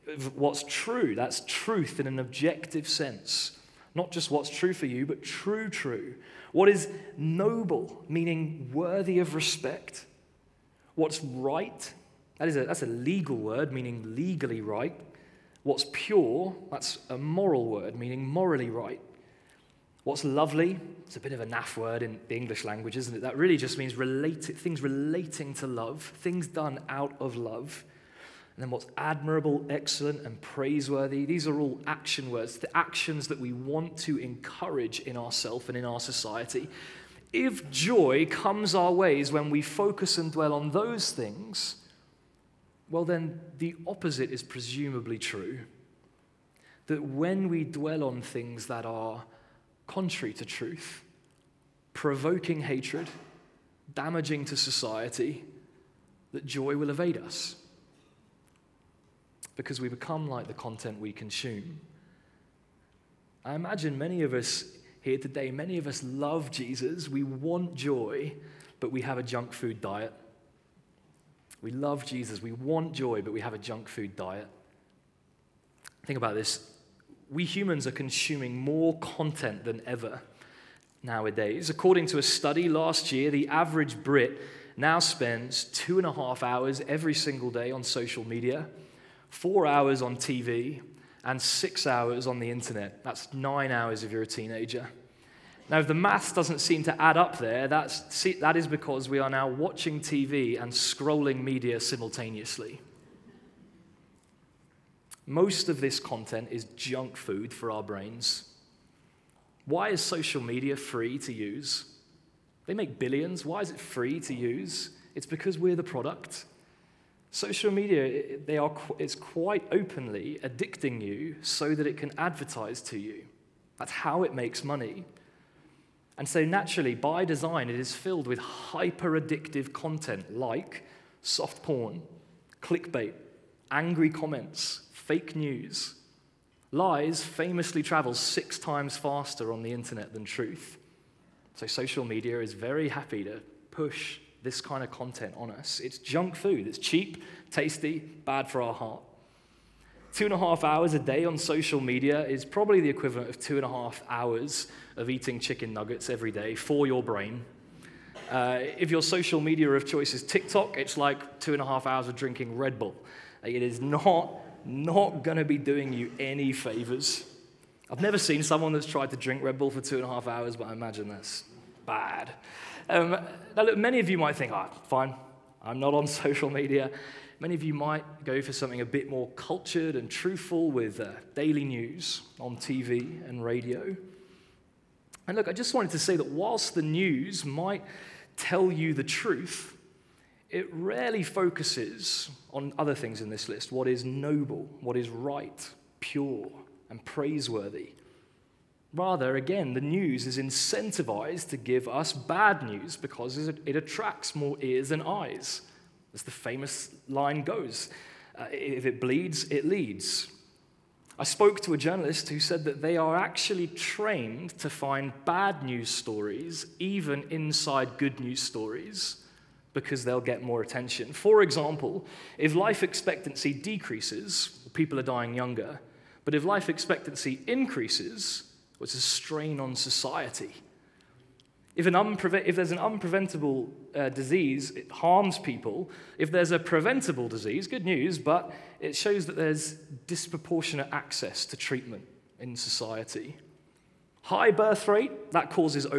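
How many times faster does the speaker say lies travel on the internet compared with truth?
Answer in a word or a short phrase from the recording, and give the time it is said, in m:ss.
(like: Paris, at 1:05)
6 times, at 2:18.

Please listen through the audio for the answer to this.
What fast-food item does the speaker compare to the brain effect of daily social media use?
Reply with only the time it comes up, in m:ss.
2:35.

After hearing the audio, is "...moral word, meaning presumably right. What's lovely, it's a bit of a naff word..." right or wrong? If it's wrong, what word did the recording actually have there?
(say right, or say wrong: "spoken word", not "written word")
wrong: "morally", not "presumably".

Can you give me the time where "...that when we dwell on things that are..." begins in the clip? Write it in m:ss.
0:46.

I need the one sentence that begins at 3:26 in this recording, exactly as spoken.
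As the famous line goes uh, if it bleeds, it leads.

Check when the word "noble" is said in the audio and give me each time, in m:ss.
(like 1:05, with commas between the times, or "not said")
0:07, 3:14.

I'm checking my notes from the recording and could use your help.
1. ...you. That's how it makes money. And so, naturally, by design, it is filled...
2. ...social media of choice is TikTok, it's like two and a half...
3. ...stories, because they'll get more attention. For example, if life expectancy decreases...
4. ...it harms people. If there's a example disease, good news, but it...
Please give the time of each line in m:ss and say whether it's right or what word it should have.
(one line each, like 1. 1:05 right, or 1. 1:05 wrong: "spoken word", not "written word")
1. 2:02 right
2. 2:39 right
3. 3:38 right
4. 3:54 wrong: "preventable", not "example".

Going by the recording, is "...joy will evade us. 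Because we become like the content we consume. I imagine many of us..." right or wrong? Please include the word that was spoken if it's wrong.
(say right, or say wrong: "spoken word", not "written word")
right.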